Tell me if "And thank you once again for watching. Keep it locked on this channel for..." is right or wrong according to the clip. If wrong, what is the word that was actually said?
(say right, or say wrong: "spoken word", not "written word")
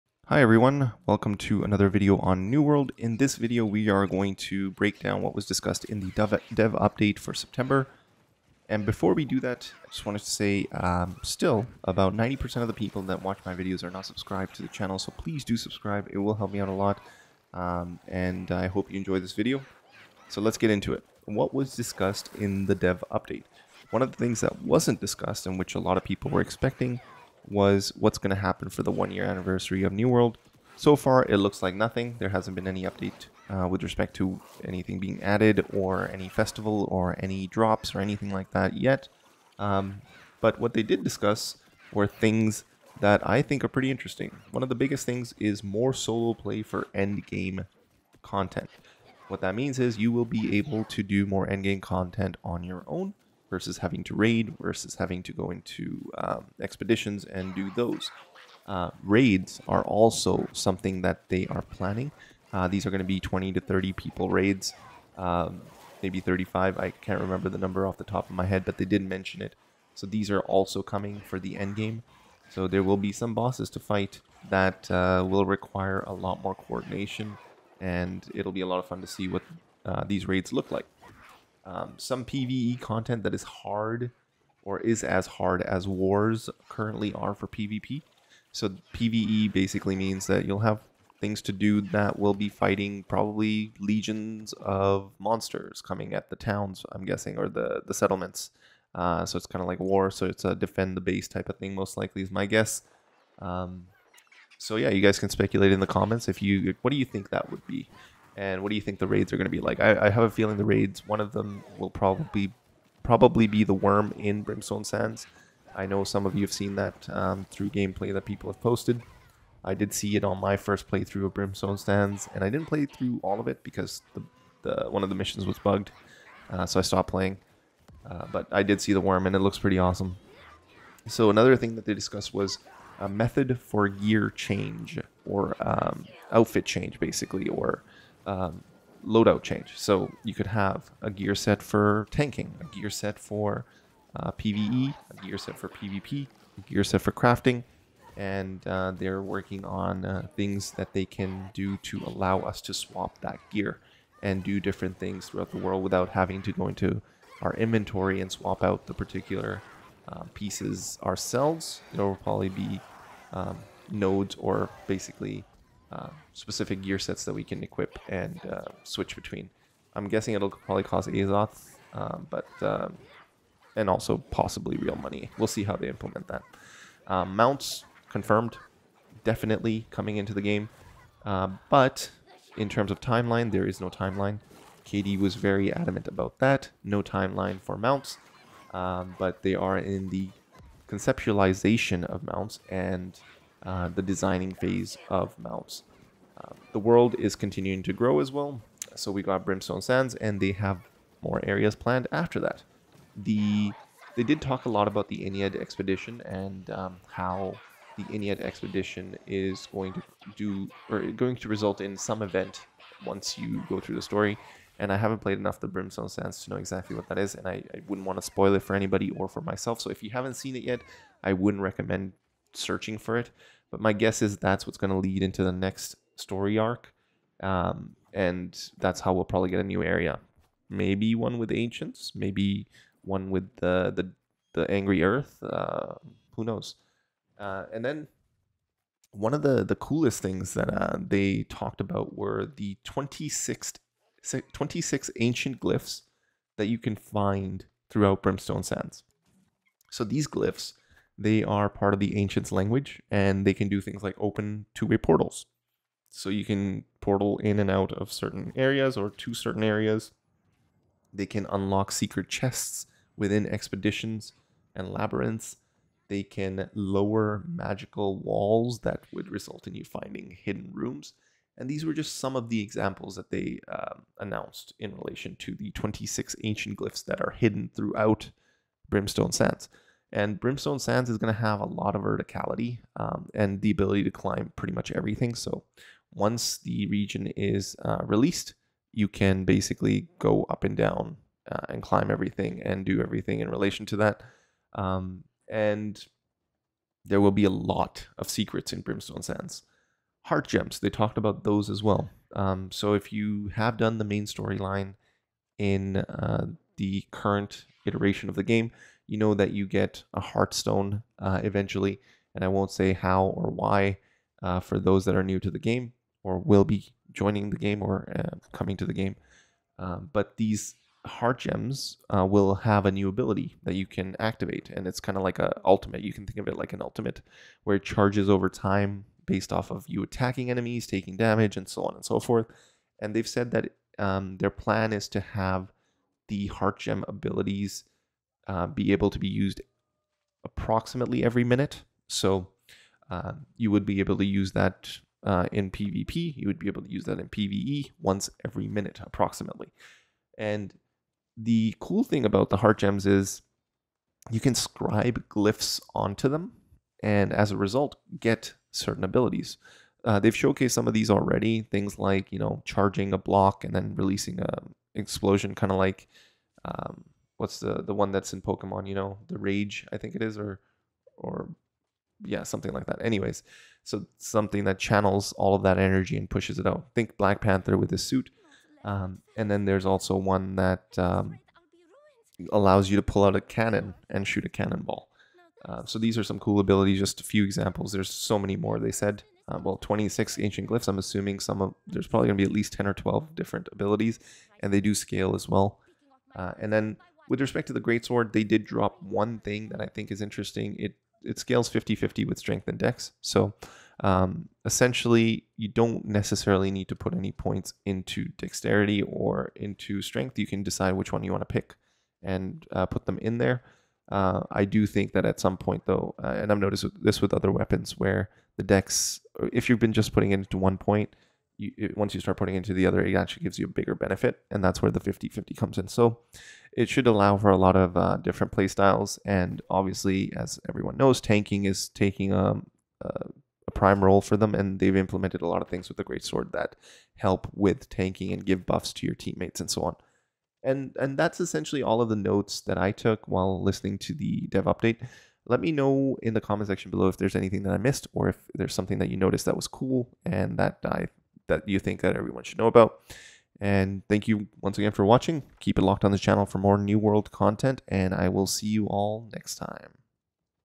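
right.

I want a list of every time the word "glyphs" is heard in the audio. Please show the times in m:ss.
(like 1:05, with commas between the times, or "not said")
4:05, 4:10, 4:36, 5:55, 6:30.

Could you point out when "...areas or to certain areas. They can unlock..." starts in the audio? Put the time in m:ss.
4:18.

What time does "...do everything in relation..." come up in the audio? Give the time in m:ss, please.
4:52.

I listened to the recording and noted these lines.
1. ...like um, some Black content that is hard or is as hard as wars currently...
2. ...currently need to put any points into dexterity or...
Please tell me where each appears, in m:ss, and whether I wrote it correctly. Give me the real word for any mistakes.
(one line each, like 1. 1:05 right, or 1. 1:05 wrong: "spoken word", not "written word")
1. 1:20 wrong: "PVE", not "Black"
2. 6:46 wrong: "necessarily", not "currently".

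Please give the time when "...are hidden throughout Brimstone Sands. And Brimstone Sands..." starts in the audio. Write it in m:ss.
4:37.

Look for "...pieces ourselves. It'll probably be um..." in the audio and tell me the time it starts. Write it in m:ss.
2:40.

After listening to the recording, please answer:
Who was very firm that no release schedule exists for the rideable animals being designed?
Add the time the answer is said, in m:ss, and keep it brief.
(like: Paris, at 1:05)
KD, at 3:04.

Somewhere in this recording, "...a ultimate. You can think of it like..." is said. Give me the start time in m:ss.
5:25.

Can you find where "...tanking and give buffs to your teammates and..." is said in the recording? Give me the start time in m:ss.
7:17.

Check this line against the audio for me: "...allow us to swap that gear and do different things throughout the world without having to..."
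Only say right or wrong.
right.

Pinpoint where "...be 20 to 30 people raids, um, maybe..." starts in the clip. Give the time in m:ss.
1:03.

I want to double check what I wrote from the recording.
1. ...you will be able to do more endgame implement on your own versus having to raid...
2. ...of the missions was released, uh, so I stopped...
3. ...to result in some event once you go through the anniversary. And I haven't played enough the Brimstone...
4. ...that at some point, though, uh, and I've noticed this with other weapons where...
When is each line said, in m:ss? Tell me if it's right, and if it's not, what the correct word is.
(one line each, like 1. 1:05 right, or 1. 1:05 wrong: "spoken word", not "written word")
1. 0:49 wrong: "content", not "implement"
2. 2:05 wrong: "bugged", not "released"
3. 3:31 wrong: "story", not "anniversary"
4. 6:55 right.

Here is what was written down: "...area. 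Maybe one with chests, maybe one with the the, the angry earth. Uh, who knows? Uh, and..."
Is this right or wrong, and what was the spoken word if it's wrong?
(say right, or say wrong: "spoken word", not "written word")
wrong: "ancients", not "chests".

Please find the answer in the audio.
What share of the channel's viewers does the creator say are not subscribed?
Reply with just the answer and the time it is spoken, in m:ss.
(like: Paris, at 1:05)
90%, at 0:12.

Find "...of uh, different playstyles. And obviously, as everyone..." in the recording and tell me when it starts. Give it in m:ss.
7:07.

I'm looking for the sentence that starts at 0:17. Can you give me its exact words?
Um, and I hope you enjoy this video.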